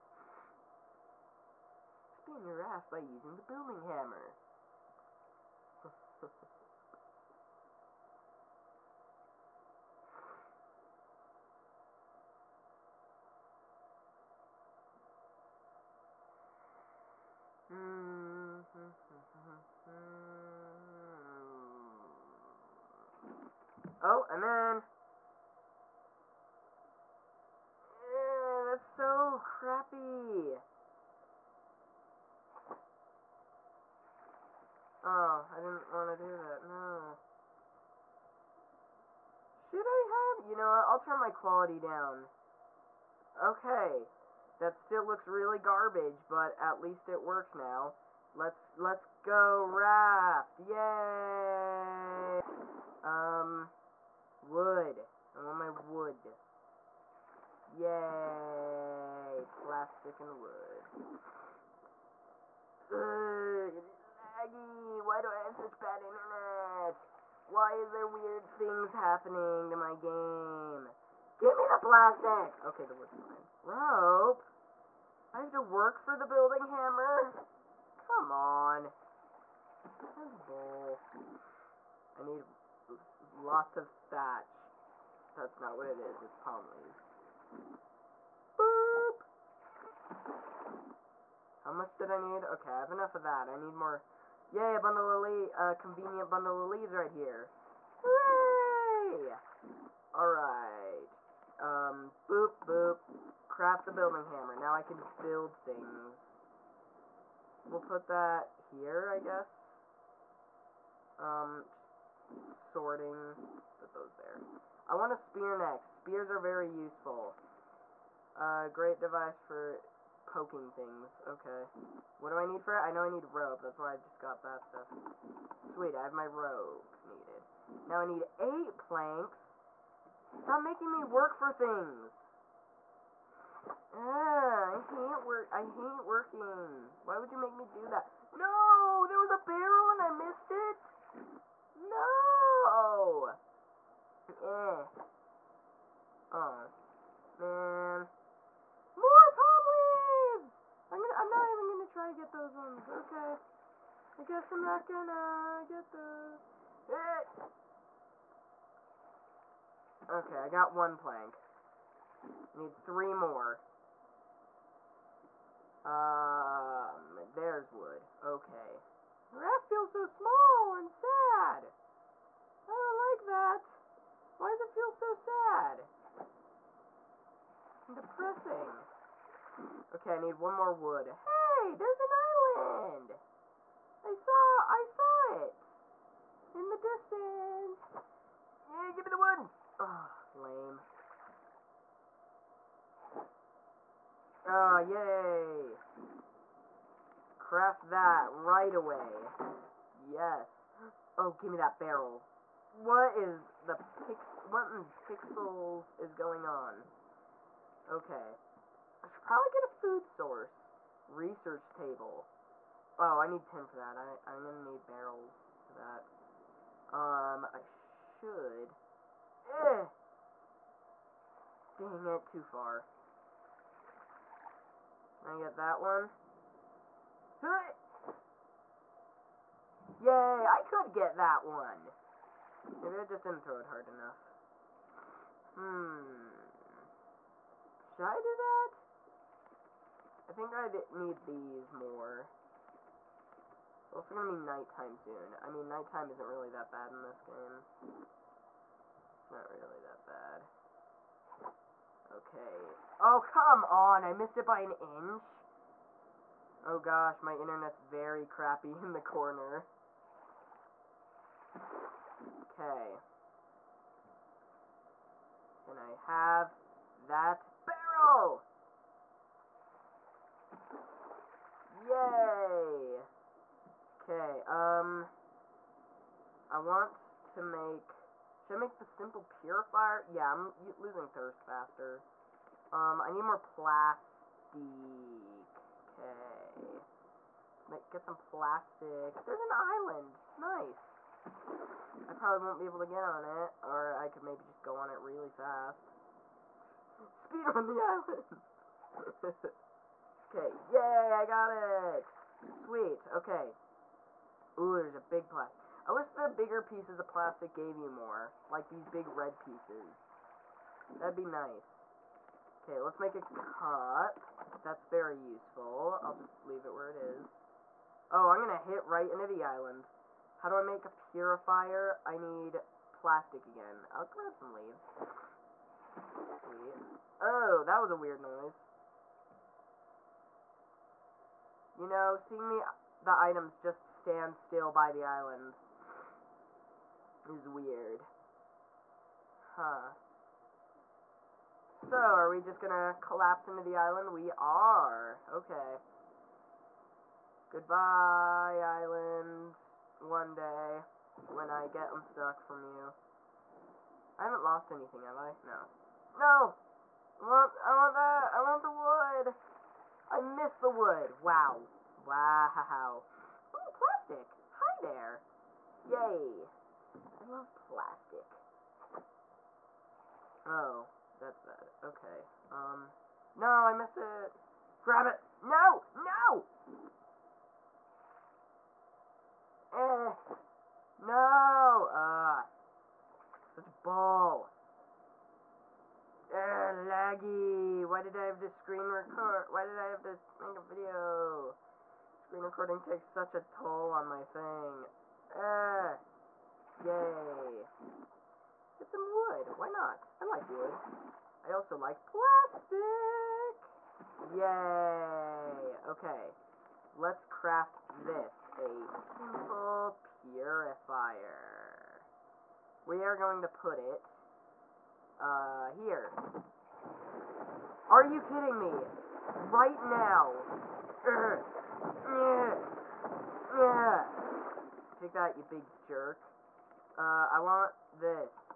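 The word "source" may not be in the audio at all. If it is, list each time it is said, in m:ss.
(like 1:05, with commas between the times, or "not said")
3:30.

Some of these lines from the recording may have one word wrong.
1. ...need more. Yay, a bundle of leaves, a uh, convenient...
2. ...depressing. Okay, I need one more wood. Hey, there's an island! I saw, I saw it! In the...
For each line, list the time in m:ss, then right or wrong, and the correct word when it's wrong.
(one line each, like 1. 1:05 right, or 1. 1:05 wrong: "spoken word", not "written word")
1. 1:33 right
2. 2:57 right.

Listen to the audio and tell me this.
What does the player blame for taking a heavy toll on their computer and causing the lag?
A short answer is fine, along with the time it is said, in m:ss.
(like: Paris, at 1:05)
screen recording, at 6:32.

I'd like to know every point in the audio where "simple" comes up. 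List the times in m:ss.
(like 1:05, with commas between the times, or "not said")
4:38, 6:48.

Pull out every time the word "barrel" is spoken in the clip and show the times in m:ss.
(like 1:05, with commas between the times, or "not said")
2:19, 3:21, 3:34, 4:27.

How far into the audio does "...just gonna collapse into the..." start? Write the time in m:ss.
5:42.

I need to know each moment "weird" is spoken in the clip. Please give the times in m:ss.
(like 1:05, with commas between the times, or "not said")
1:08, 5:27, 5:37.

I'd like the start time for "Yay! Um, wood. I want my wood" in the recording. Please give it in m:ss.
0:50.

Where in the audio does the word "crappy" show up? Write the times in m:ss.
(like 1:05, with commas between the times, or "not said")
0:29, 4:18.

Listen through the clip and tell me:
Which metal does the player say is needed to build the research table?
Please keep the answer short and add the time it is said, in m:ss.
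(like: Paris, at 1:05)
tin, at 3:33.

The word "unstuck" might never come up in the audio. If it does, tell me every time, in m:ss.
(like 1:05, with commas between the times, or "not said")
5:51.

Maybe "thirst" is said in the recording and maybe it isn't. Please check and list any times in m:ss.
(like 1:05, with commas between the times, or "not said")
4:41.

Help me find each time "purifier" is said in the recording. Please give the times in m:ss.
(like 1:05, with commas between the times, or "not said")
4:39, 5:21, 6:50.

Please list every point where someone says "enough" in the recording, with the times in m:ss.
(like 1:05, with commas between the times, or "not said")
1:32, 3:53.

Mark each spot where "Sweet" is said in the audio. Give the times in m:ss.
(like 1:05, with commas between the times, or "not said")
2:05, 5:02, 5:26.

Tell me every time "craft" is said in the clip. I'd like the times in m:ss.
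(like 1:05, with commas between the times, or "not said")
1:43, 3:17, 6:47.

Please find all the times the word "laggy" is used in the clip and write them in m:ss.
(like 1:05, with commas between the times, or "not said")
1:03, 6:26.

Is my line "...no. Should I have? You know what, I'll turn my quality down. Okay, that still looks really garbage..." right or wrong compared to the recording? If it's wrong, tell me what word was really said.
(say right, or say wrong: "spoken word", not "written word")
right.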